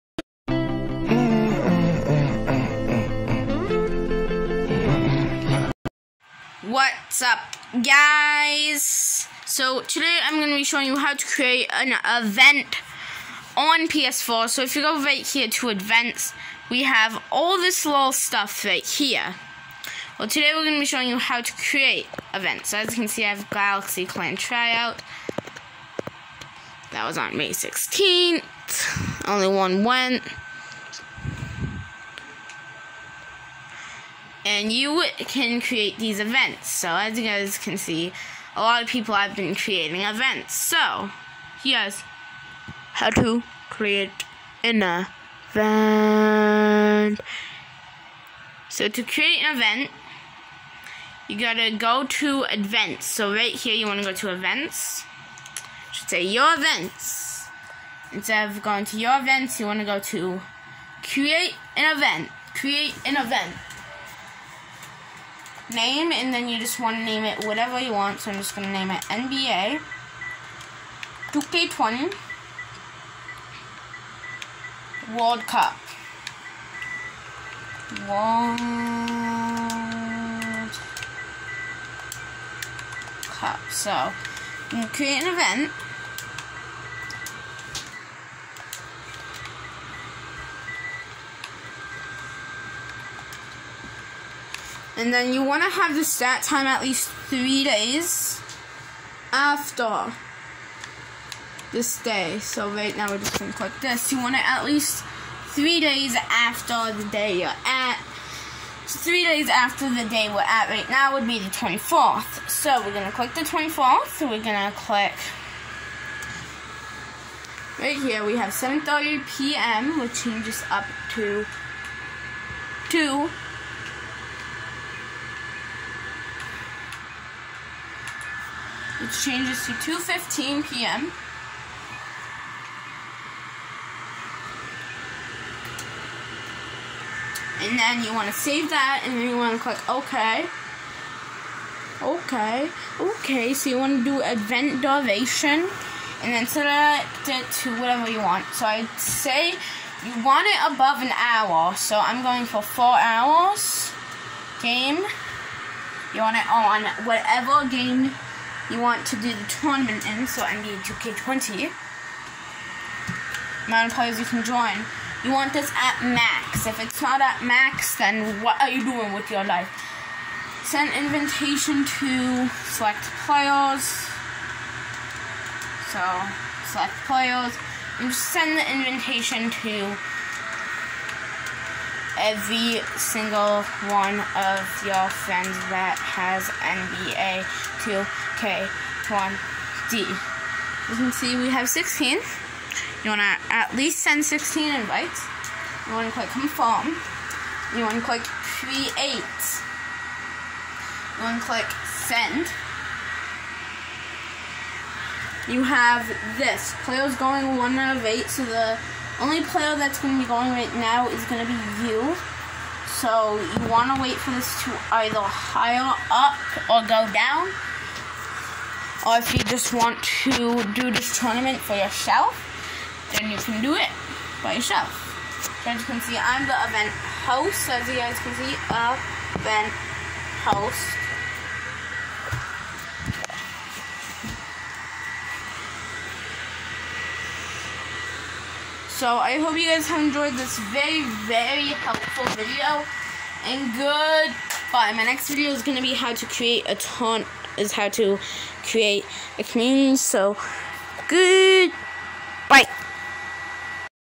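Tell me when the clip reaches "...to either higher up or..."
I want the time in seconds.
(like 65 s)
214 s.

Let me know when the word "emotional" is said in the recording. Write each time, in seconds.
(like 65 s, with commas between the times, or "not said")
not said.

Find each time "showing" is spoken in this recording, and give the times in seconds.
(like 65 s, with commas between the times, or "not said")
10 s, 20 s.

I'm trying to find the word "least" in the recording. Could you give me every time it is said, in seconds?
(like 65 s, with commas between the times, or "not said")
96 s, 104 s, 193 s.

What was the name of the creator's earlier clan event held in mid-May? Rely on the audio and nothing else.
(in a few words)
Galaxy Clan Tryout.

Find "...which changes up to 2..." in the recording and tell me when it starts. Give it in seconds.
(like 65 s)
119 s.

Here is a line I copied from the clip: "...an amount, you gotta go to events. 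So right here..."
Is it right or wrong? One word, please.
wrong.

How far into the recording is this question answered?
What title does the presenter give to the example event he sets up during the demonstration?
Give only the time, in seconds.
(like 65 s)
69 s.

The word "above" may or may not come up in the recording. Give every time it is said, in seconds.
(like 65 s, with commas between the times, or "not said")
150 s.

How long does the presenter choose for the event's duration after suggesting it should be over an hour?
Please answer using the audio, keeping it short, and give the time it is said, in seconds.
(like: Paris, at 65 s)
4 hours, at 152 s.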